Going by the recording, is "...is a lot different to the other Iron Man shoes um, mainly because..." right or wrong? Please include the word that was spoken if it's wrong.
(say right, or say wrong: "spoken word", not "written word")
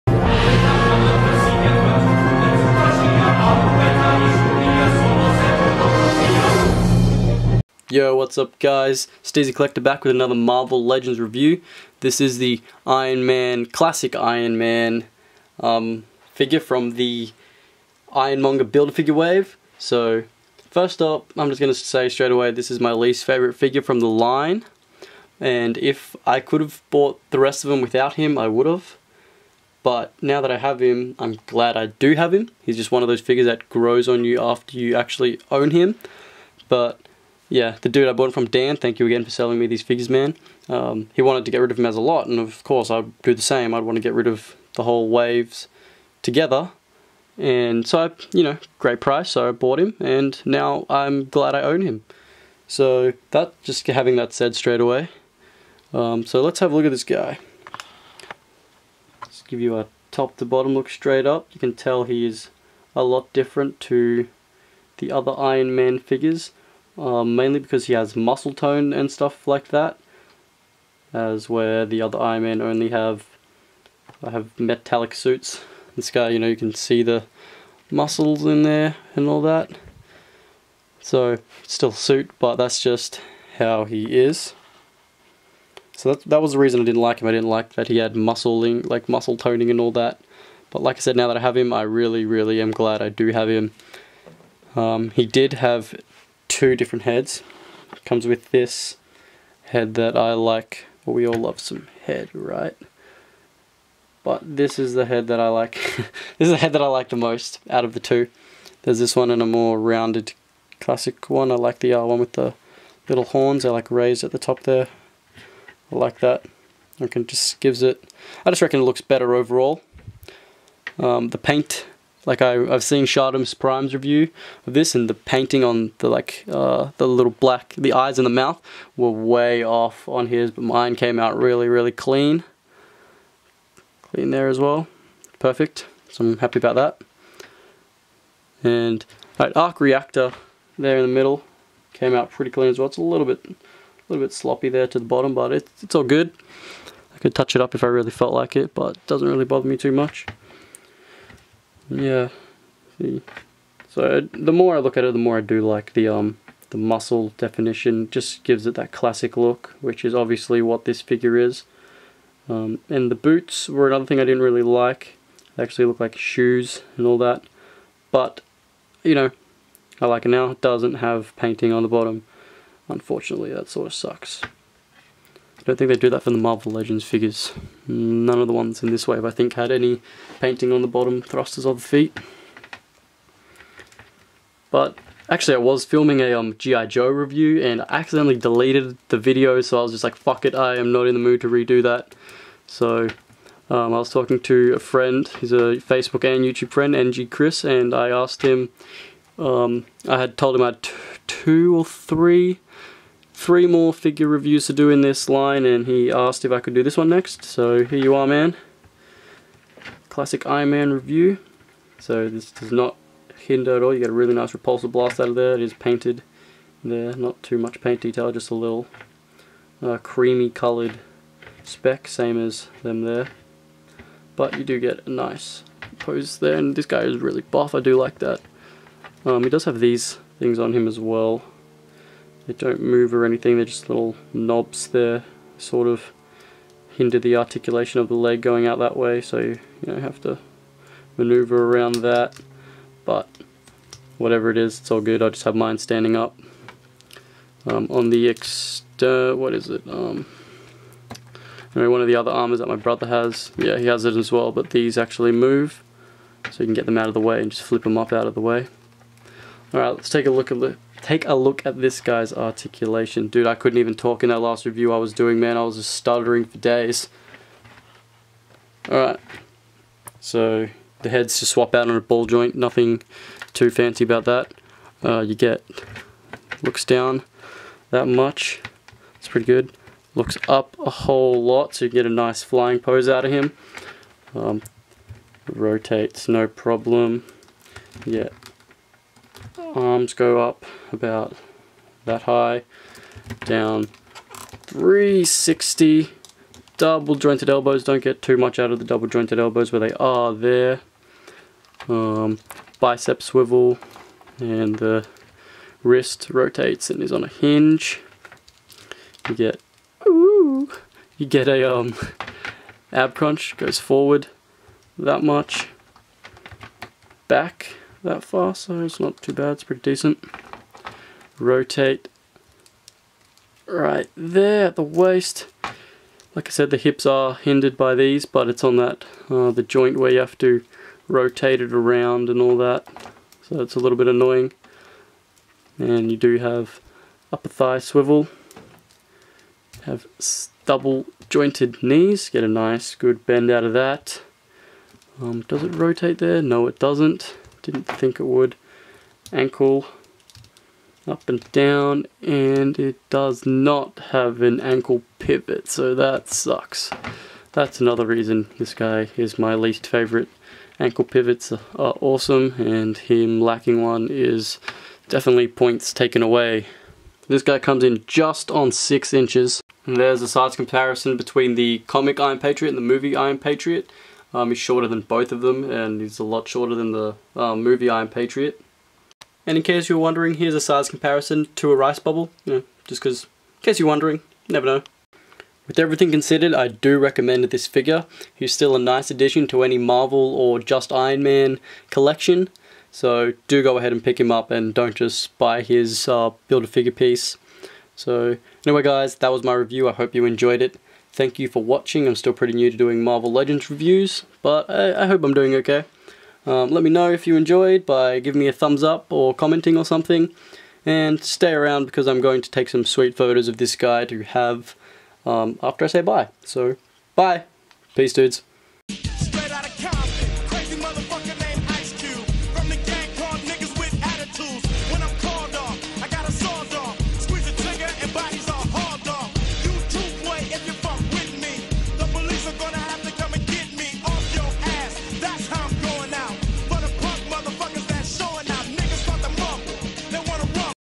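wrong: "figures", not "shoes".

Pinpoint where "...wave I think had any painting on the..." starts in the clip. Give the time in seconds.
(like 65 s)
179 s.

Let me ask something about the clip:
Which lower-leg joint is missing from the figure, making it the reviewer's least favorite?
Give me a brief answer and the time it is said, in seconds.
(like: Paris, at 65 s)
ankle pivot, at 354 s.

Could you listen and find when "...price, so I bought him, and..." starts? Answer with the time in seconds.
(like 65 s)
49 s.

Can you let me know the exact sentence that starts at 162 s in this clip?
Um, and the boots were another thing I didn't really like.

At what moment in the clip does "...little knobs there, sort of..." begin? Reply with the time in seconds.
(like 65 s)
233 s.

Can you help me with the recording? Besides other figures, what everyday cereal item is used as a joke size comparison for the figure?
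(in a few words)
a rice bubble.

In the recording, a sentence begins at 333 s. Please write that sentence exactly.
So it's a little bit annoying.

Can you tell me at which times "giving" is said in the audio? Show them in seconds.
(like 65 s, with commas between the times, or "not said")
408 s.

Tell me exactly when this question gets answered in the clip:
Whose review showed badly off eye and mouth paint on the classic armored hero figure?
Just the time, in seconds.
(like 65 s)
123 s.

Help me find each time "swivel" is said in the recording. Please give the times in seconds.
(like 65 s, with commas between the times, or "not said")
303 s, 337 s.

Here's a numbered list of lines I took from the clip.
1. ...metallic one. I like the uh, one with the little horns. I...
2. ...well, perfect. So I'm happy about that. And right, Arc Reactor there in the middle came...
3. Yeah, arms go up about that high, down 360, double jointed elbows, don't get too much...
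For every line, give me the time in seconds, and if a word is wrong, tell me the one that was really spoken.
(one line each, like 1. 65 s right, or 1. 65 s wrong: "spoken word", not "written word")
1. 110 s wrong: "classic", not "metallic"
2. 134 s right
3. 288 s right.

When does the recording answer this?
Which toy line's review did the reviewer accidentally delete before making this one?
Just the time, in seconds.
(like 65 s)
186 s.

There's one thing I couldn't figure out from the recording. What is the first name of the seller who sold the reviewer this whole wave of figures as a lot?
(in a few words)
Dan.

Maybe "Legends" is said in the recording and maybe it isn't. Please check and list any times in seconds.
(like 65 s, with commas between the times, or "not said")
10 s, 176 s, 403 s.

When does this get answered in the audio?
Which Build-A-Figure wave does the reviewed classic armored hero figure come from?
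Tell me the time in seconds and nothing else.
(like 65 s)
18 s.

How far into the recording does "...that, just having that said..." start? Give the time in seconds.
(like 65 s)
53 s.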